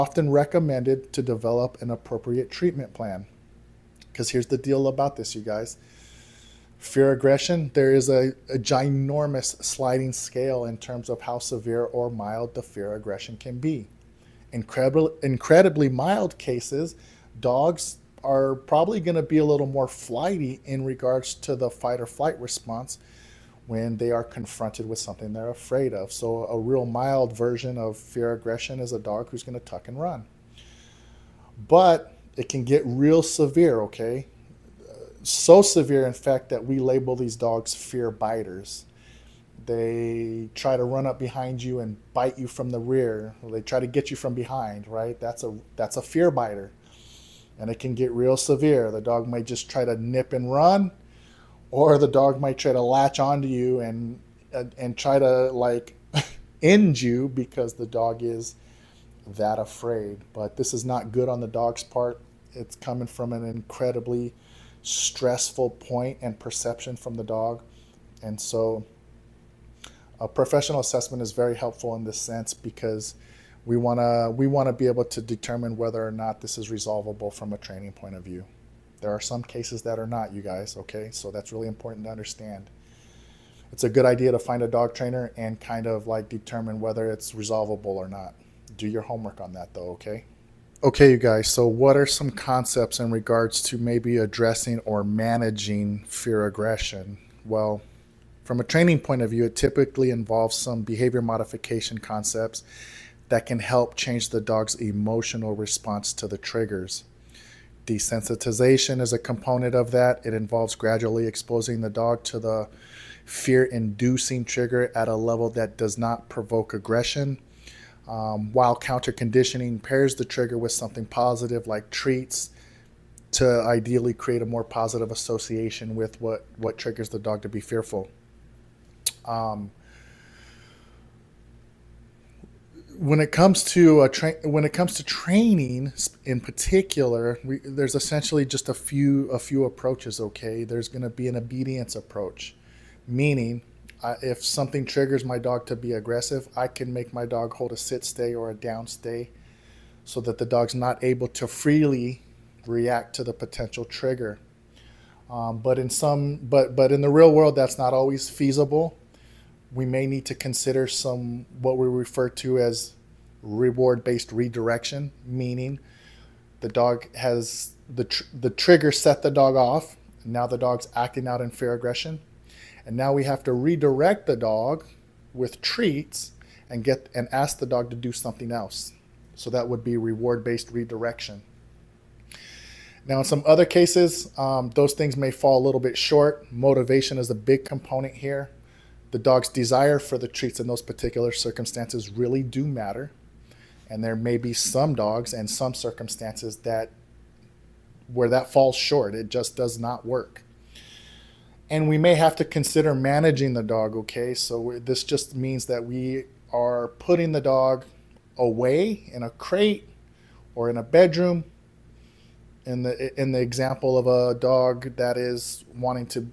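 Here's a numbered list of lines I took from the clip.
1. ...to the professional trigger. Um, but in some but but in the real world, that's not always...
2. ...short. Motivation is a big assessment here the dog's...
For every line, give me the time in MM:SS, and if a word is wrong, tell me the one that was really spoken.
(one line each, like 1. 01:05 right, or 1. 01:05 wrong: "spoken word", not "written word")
1. 02:33 wrong: "potential", not "professional"
2. 03:05 wrong: "component", not "assessment".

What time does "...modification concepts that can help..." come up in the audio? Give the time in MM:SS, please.
01:41.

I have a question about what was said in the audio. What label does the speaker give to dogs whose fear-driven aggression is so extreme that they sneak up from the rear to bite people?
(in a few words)
fear biters.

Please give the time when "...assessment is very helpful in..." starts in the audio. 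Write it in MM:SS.
01:10.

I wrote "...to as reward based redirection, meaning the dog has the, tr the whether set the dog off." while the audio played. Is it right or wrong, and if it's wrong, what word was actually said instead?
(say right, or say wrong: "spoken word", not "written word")
wrong: "trigger", not "whether".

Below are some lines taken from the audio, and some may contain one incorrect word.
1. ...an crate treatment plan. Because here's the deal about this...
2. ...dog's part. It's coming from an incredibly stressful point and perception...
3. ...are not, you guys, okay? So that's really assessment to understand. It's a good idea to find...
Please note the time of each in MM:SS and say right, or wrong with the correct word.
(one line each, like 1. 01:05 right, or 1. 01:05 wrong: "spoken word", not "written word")
1. 00:01 wrong: "appropriate", not "crate"
2. 01:01 right
3. 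01:19 wrong: "important", not "assessment".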